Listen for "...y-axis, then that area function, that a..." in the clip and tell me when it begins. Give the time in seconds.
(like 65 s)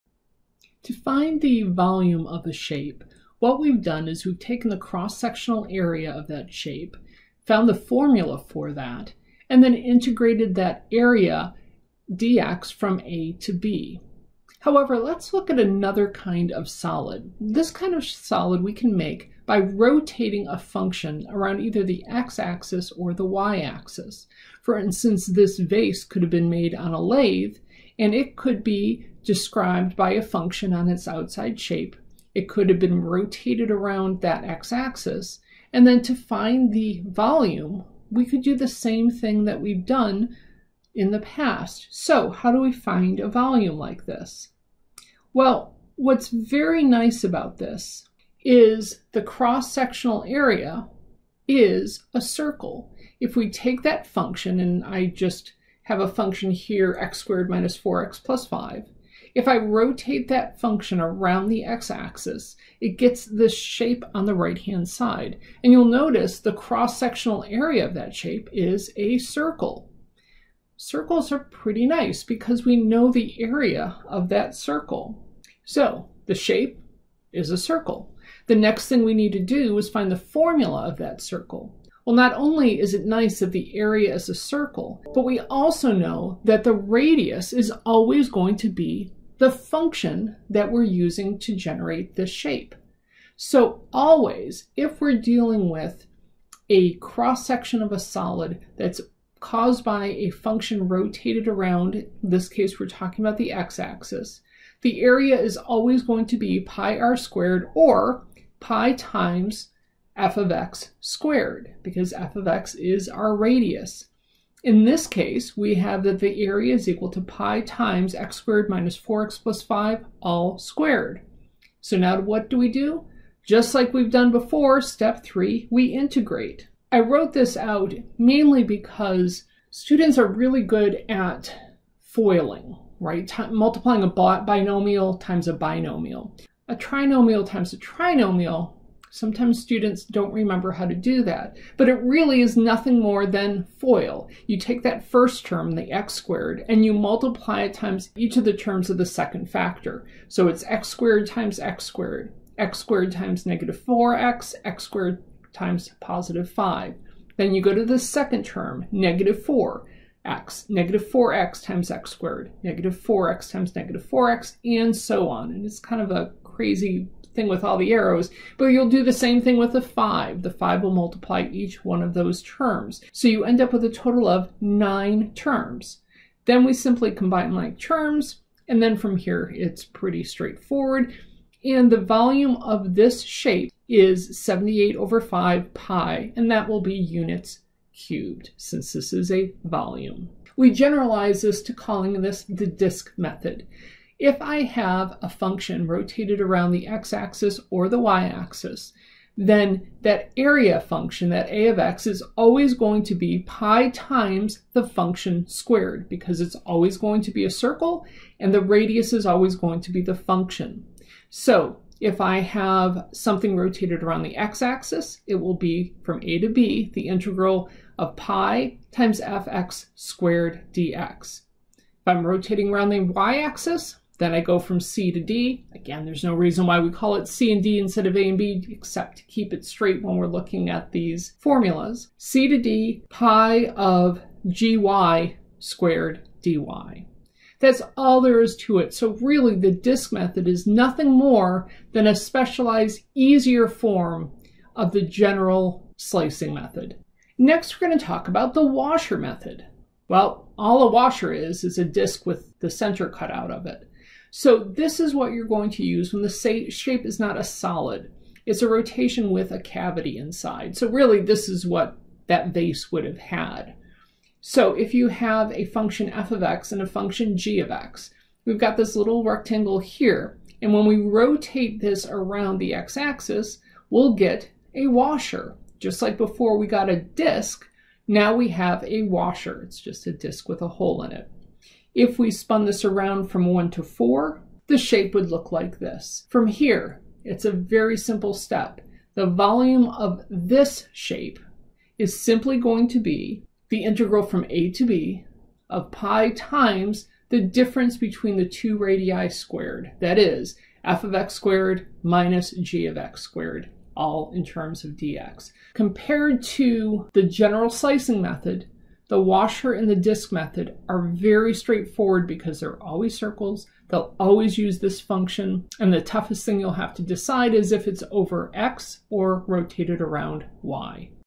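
197 s.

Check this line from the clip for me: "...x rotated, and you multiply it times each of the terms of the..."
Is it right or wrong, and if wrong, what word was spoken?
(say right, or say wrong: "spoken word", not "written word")
wrong: "squared", not "rotated".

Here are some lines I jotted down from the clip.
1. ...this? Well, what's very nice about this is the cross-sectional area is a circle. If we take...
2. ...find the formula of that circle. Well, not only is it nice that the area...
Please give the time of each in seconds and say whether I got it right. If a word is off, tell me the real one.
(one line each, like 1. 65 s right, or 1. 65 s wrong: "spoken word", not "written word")
1. 44 s right
2. 79 s right.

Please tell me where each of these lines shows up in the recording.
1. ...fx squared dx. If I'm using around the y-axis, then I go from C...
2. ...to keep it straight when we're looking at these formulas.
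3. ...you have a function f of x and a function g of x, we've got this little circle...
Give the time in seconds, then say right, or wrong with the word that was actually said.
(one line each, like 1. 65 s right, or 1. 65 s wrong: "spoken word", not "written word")
1. 219 s wrong: "rotating", not "using"
2. 229 s right
3. 264 s wrong: "rectangle", not "circle".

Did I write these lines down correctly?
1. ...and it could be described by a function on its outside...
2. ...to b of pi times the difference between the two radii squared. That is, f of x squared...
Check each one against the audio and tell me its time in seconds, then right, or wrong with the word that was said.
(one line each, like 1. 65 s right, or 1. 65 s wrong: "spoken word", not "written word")
1. 27 s right
2. 294 s right.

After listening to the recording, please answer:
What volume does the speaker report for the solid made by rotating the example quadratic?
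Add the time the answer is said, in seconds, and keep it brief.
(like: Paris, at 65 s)
78/5 pi, at 184 s.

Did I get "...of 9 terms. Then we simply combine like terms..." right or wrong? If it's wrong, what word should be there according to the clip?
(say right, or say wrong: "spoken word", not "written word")
right.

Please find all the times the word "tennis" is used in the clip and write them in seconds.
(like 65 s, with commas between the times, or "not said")
not said.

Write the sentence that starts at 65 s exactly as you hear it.
And you'll notice the cross-sectional area of that shape is a circle.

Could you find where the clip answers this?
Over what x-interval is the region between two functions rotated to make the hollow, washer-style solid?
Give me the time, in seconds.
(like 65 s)
283 s.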